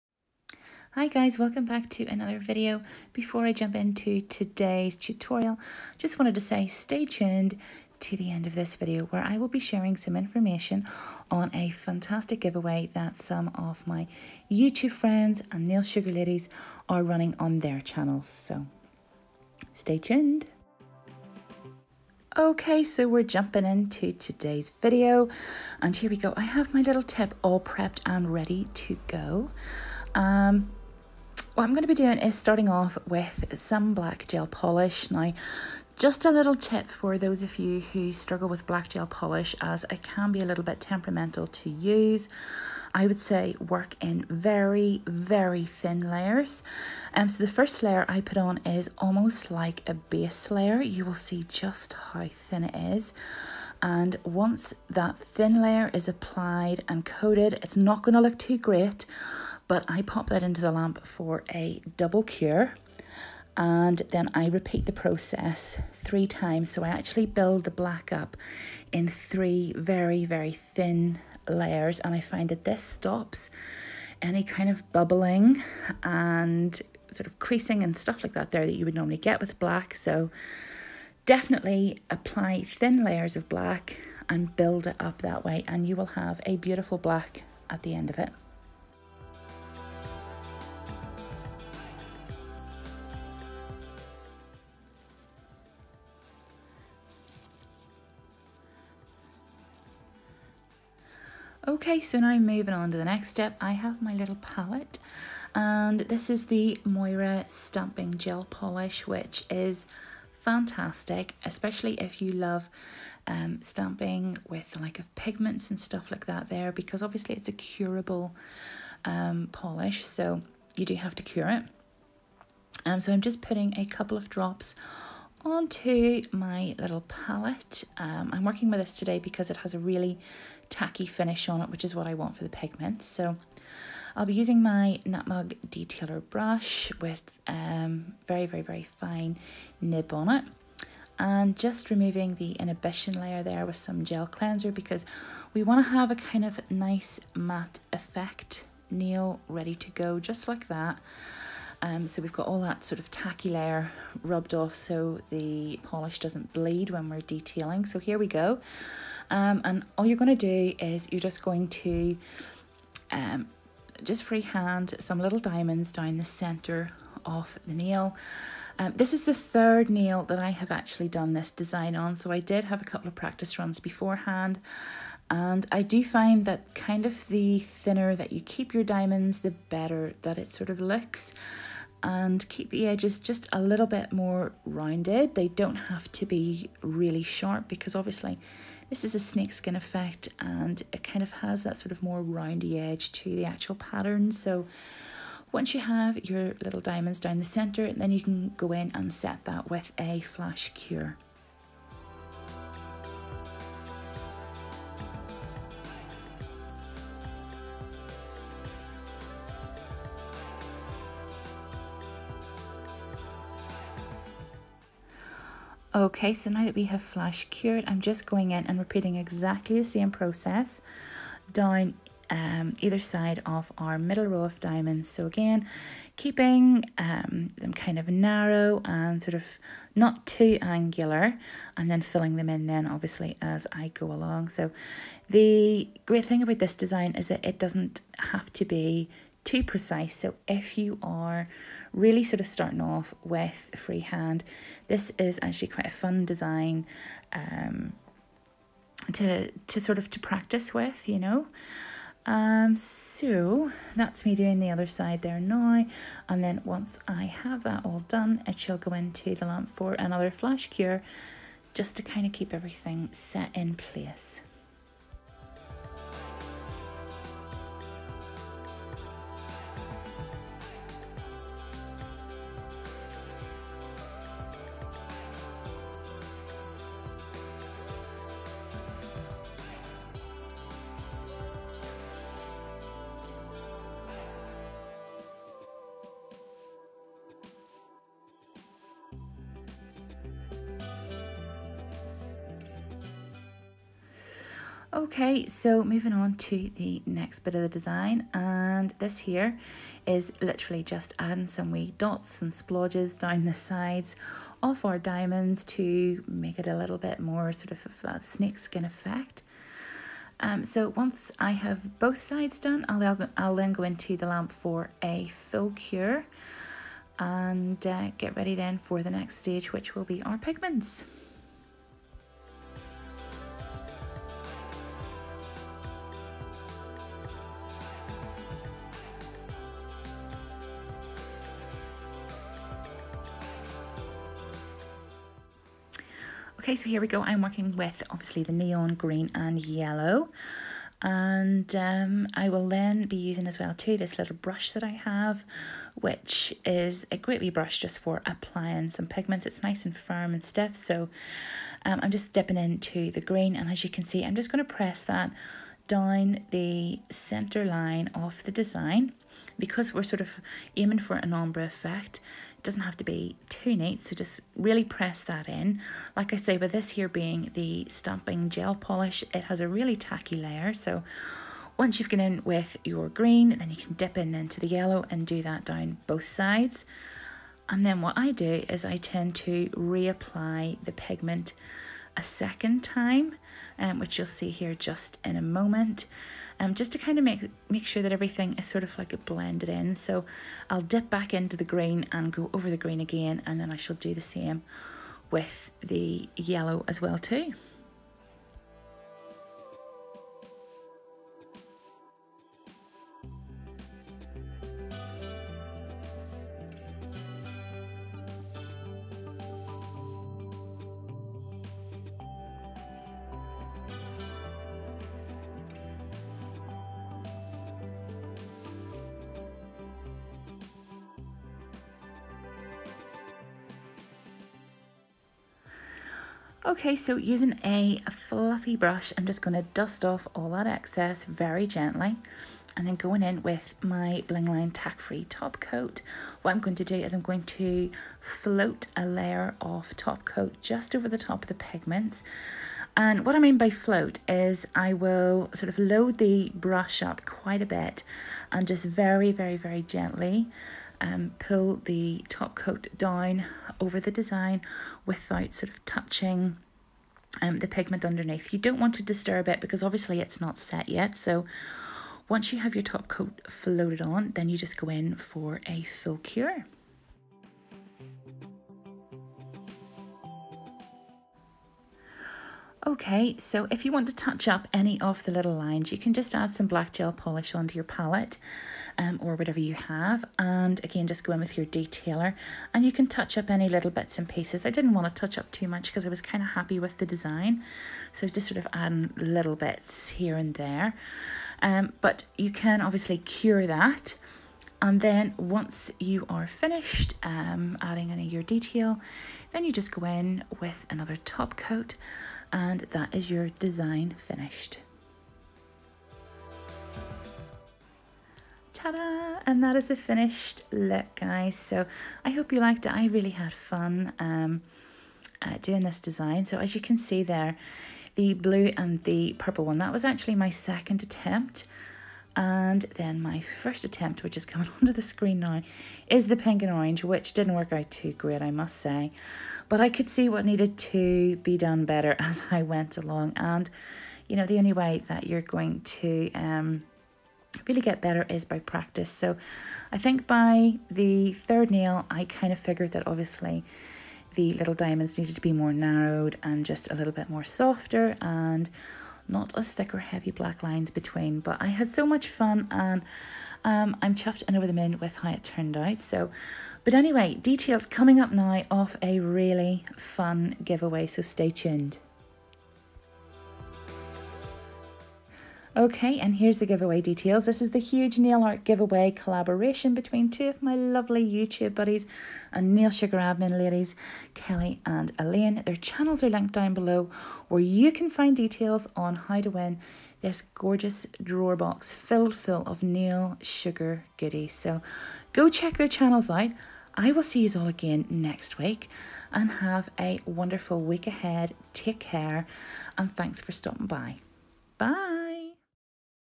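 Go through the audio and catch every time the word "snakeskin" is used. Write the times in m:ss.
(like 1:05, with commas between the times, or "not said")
3:09, 5:08.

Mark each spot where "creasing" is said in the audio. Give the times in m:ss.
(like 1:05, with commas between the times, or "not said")
1:17.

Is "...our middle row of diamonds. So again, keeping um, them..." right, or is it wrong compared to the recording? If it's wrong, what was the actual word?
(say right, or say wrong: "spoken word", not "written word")
right.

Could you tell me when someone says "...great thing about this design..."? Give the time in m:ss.
3:56.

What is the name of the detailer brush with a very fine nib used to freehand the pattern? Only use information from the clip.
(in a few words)
Nutmeg Detailer.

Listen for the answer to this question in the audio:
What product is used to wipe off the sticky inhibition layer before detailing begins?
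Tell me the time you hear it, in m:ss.
2:24.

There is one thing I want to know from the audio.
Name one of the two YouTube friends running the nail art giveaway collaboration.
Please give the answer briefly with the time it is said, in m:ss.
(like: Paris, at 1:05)
Kelly, at 9:34.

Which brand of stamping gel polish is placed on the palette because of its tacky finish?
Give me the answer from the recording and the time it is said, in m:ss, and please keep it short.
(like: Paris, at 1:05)
Moyra, at 1:46.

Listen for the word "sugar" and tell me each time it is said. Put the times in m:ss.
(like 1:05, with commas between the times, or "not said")
0:15, 9:32, 9:43.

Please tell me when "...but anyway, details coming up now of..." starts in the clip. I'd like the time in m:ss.
9:16.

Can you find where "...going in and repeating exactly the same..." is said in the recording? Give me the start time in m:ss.
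3:38.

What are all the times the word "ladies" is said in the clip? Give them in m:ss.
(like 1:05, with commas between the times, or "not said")
0:16, 9:33.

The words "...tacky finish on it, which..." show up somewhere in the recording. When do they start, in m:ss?
2:10.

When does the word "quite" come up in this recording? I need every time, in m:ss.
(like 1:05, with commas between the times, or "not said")
4:05, 7:27.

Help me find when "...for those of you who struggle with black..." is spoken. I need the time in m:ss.
0:36.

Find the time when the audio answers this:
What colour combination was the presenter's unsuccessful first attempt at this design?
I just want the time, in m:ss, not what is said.
8:46.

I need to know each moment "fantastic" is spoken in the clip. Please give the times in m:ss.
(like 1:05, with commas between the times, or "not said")
0:11, 1:50.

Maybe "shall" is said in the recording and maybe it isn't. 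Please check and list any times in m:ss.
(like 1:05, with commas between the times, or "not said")
4:18, 6:33.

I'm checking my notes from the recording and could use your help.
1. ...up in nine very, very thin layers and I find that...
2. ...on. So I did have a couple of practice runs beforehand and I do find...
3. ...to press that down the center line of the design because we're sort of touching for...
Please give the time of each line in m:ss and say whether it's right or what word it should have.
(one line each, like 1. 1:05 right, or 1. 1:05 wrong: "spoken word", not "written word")
1. 1:08 wrong: "three", not "nine"
2. 2:51 right
3. 5:54 wrong: "aiming", not "touching".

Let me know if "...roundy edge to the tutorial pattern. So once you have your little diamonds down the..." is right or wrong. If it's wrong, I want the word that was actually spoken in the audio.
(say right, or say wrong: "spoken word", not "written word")
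wrong: "actual", not "tutorial".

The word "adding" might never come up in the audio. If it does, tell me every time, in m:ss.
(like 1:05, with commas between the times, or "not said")
5:01, 8:08, 8:17.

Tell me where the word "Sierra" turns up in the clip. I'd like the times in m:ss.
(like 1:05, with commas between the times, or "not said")
not said.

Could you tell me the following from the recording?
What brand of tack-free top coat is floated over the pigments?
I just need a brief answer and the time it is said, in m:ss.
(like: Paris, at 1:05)
Blingline, at 7:14.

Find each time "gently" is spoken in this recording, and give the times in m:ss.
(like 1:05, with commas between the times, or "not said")
7:11, 7:29.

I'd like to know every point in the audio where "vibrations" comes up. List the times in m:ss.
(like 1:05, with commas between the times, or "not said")
not said.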